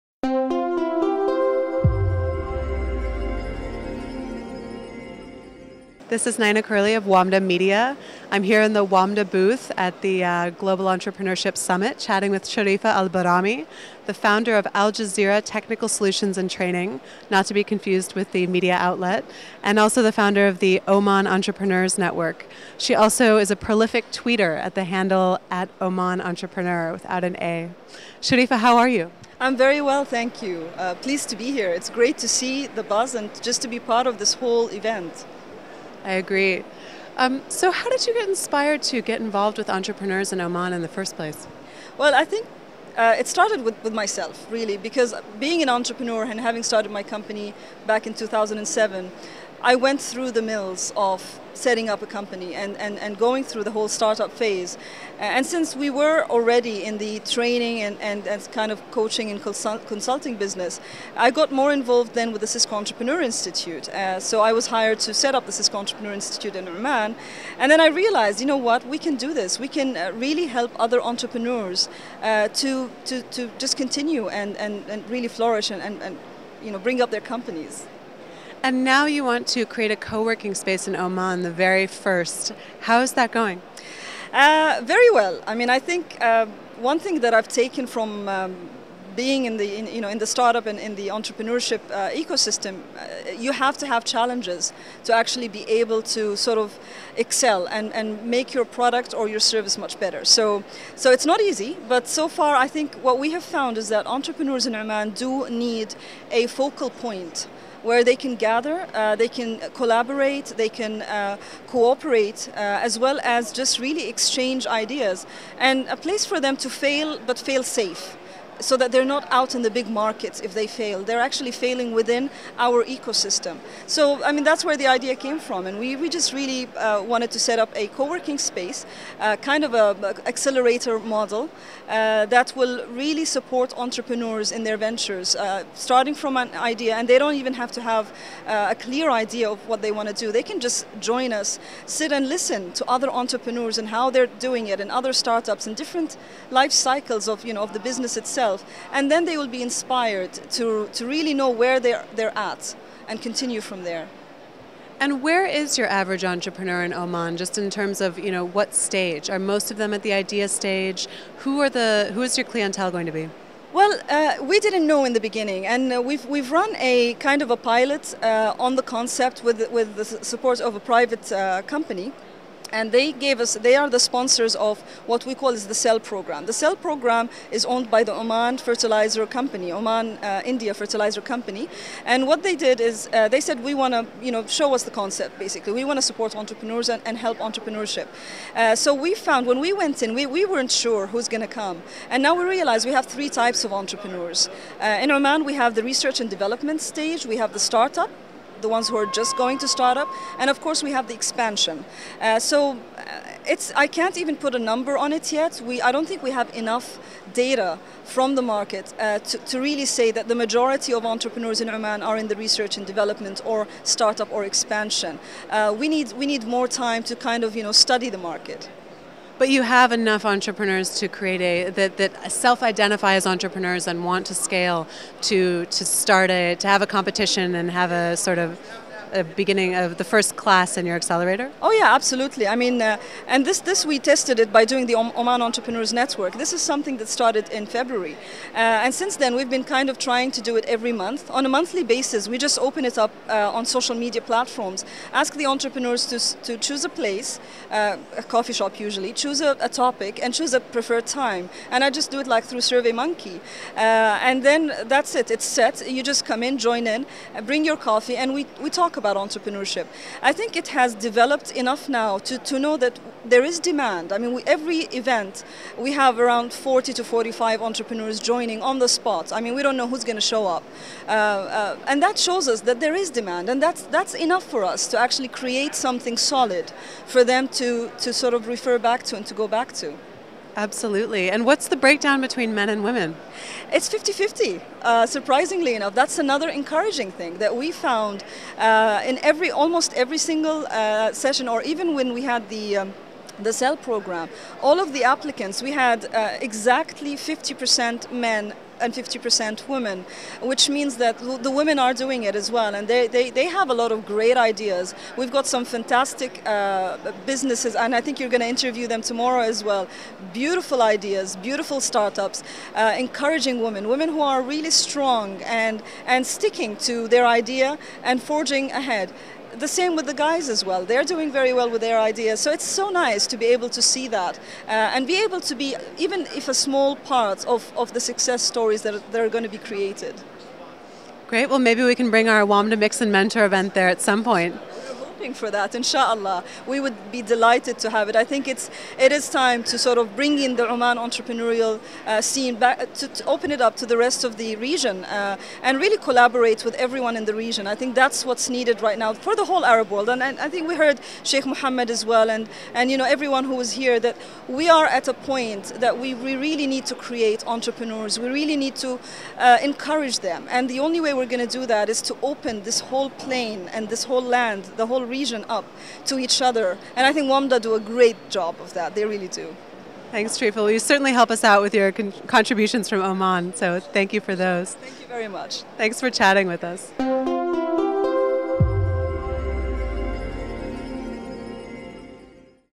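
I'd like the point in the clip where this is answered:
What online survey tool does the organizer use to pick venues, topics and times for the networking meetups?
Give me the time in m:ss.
4:12.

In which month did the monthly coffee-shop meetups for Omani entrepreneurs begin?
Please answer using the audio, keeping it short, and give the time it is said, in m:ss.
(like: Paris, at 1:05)
February, at 3:57.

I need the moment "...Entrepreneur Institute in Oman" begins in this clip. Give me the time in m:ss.
1:05.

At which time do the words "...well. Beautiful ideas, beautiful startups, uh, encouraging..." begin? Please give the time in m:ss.
5:09.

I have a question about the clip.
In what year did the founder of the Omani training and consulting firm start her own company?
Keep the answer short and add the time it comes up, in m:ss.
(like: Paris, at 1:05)
2007, at 0:48.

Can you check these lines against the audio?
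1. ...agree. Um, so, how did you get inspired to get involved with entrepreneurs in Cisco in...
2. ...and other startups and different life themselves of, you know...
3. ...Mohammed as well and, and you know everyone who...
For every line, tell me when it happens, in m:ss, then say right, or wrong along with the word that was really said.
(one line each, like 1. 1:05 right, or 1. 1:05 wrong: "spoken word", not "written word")
1. 0:36 wrong: "Oman", not "Cisco"
2. 2:24 wrong: "cycles", not "themselves"
3. 5:51 right.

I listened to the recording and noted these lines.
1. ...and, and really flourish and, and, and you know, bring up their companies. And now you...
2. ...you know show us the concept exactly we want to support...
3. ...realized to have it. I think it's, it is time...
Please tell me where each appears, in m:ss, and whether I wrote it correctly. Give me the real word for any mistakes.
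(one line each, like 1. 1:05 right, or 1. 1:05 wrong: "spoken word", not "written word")
1. 1:14 right
2. 3:04 wrong: "basically", not "exactly"
3. 5:37 wrong: "delighted", not "realized".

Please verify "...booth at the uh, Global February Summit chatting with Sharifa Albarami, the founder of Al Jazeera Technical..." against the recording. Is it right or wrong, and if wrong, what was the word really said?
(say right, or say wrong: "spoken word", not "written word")
wrong: "Entrepreneurship", not "February".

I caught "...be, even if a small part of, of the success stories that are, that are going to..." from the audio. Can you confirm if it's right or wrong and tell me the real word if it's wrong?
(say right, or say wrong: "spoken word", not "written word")
right.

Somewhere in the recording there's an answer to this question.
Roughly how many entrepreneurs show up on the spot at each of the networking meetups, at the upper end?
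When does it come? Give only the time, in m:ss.
4:27.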